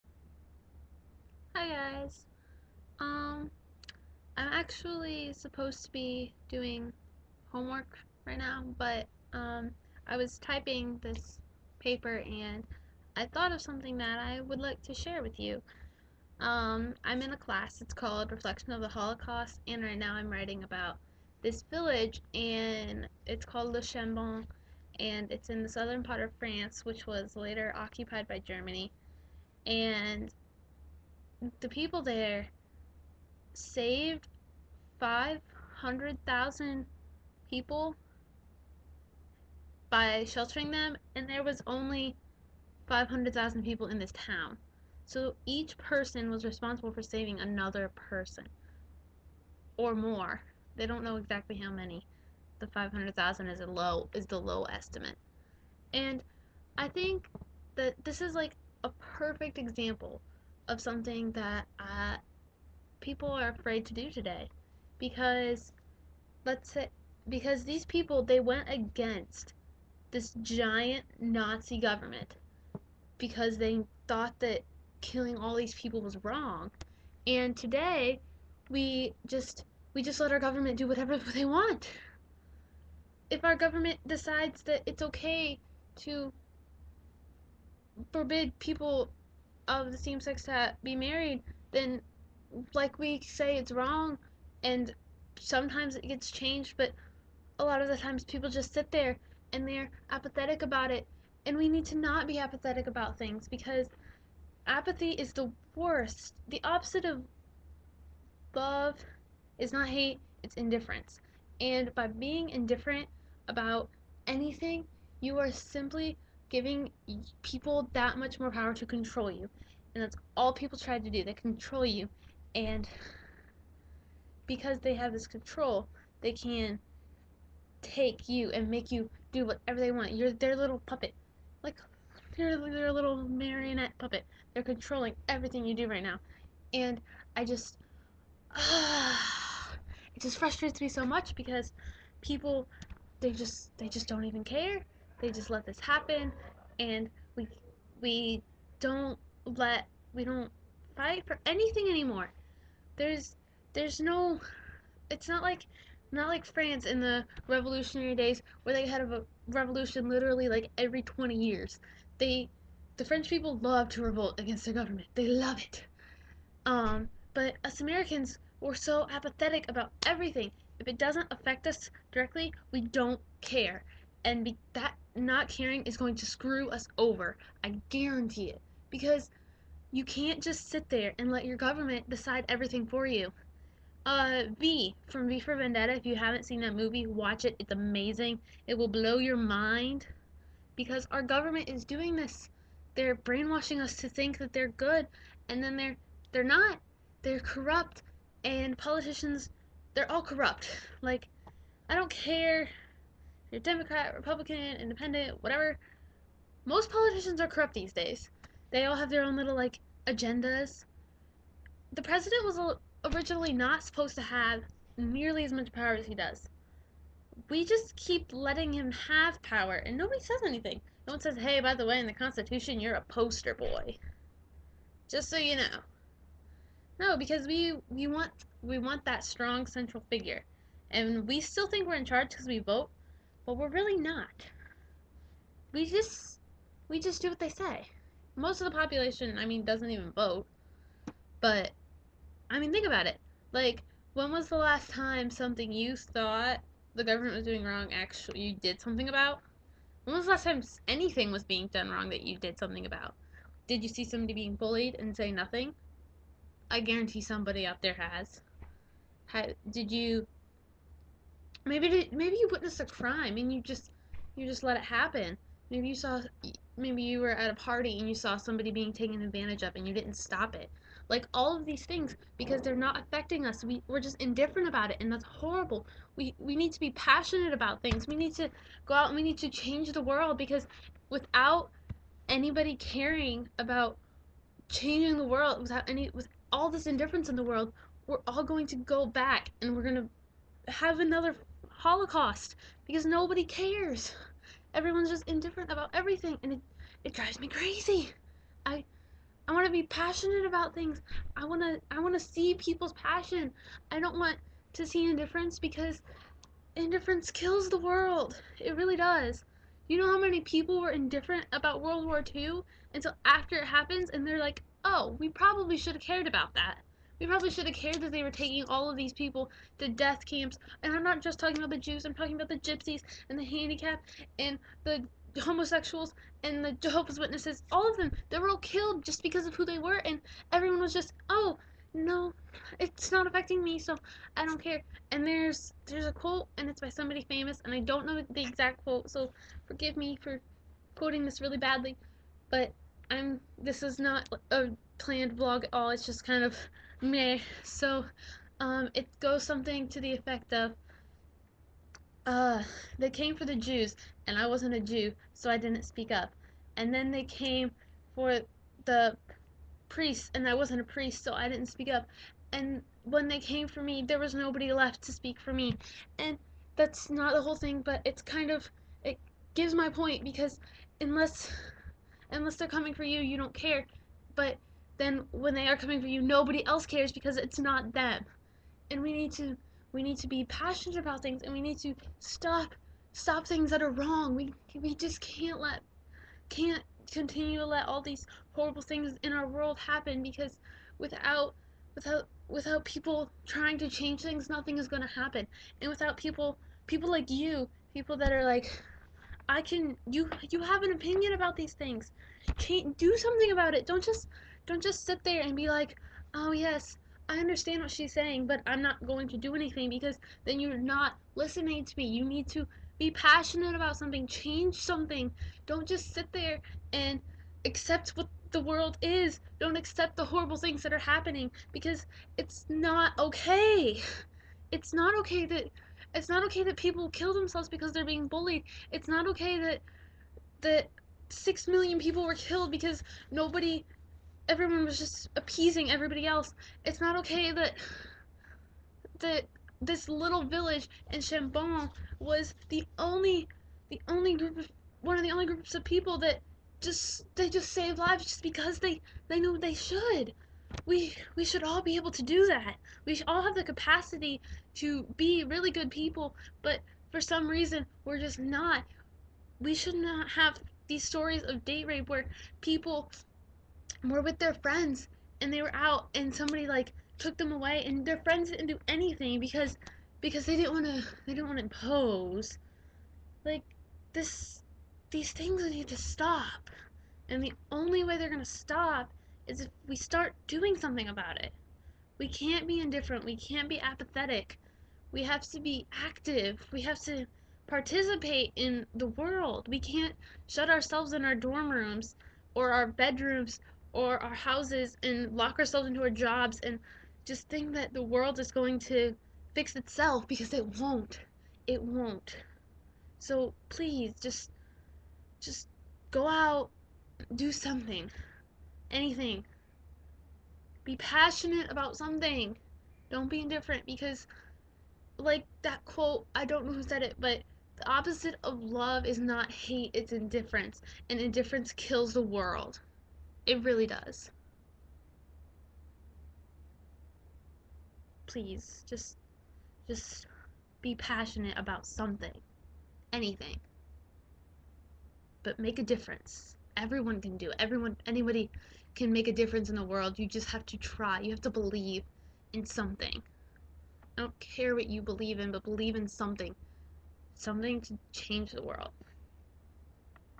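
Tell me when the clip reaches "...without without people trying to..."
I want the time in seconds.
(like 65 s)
391 s.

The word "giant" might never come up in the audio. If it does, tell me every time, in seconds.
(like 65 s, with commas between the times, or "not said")
70 s.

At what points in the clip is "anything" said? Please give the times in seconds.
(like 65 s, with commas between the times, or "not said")
114 s, 151 s, 220 s, 250 s, 409 s, 468 s, 508 s, 533 s.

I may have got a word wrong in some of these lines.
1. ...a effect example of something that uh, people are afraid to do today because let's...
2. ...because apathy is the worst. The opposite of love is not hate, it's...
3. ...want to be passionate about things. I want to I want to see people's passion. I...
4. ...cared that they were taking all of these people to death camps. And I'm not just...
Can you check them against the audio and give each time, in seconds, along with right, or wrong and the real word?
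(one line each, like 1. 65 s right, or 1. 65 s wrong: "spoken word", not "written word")
1. 58 s wrong: "perfect", not "effect"
2. 103 s right
3. 299 s right
4. 317 s right.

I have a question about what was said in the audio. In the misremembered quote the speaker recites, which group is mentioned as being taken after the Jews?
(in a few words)
Priests.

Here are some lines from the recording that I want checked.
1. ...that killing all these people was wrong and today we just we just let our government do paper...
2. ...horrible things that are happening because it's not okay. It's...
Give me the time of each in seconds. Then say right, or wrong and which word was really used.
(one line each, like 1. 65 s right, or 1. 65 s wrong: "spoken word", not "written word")
1. 74 s wrong: "whatever", not "paper"
2. 420 s right.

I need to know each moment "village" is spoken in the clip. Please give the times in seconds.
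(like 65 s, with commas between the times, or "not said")
21 s, 440 s.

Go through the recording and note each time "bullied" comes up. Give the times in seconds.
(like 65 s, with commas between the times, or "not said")
254 s, 428 s.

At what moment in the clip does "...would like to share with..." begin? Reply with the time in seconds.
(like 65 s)
14 s.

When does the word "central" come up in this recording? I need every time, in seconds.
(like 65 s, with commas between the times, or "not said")
229 s.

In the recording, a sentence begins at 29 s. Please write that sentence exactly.
And the people there saved 500,000 people by sheltering them, and there was only 500,000 people in this town.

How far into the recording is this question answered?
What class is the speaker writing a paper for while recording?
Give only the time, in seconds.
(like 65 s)
18 s.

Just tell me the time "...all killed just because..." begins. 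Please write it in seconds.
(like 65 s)
328 s.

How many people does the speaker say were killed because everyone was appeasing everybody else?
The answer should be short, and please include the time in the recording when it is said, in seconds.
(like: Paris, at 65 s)
6 million, at 431 s.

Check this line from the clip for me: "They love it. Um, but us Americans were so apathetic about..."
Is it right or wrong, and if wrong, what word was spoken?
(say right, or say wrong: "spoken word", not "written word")
right.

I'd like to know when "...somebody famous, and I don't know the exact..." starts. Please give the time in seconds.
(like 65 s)
336 s.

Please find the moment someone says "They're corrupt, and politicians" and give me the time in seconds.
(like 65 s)
197 s.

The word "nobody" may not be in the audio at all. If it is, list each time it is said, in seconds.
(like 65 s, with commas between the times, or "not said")
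219 s, 293 s, 364 s, 376 s, 433 s.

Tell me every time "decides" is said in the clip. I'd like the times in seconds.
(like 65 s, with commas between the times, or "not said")
84 s, 182 s.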